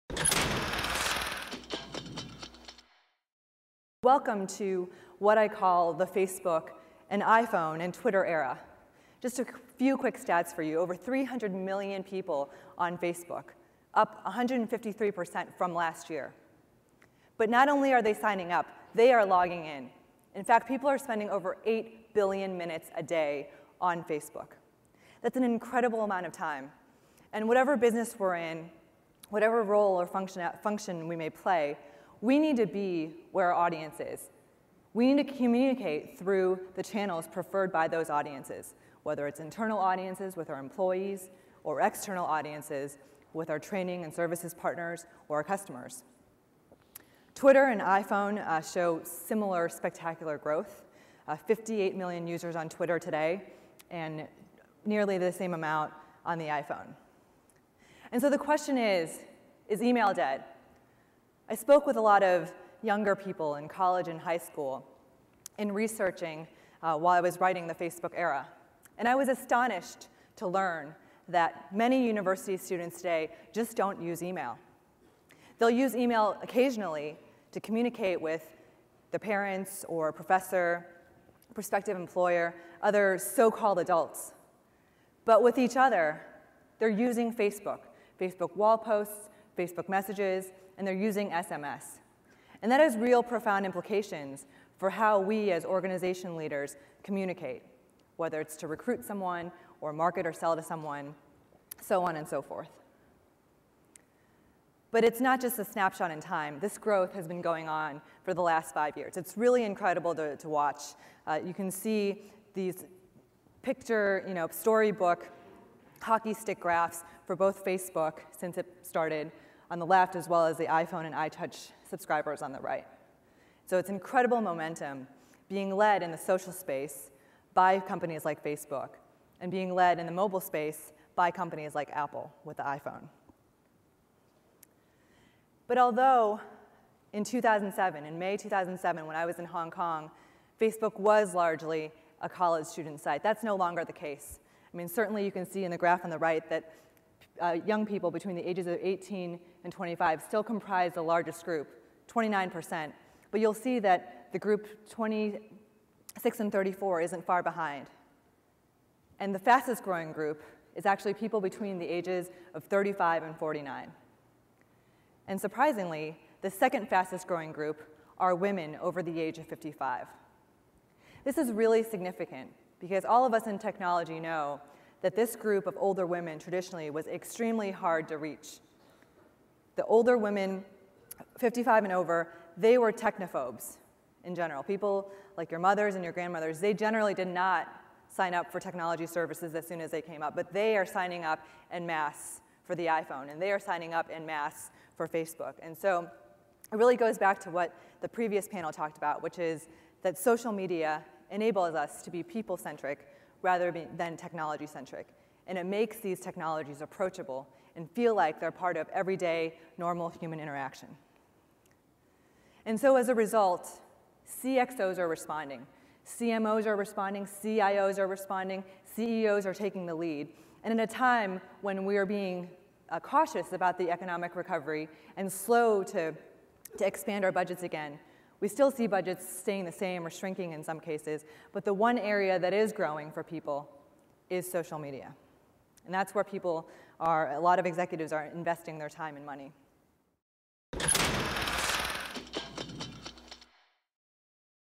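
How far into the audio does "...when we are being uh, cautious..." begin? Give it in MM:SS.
03:41.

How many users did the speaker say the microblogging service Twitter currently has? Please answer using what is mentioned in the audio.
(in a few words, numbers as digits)
58 million.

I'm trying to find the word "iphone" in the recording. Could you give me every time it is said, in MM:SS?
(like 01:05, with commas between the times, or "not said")
00:07, 00:47, 00:56, 02:00, 02:12, 03:12.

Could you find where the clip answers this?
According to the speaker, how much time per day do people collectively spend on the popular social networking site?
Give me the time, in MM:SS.
00:21.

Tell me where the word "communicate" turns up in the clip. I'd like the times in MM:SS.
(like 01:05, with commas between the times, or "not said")
00:35, 01:17, 01:37.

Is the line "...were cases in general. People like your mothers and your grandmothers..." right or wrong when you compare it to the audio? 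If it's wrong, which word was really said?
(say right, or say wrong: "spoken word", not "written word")
wrong: "technophobes", not "cases".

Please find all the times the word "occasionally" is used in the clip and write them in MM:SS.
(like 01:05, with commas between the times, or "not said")
01:16.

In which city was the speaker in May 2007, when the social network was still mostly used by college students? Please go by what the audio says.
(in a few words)
Hong Kong.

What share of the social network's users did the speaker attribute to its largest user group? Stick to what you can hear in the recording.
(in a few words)
29%.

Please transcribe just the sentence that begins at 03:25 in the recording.
And it makes these technologies approachable and feel like they're part of everyday, normal human interaction.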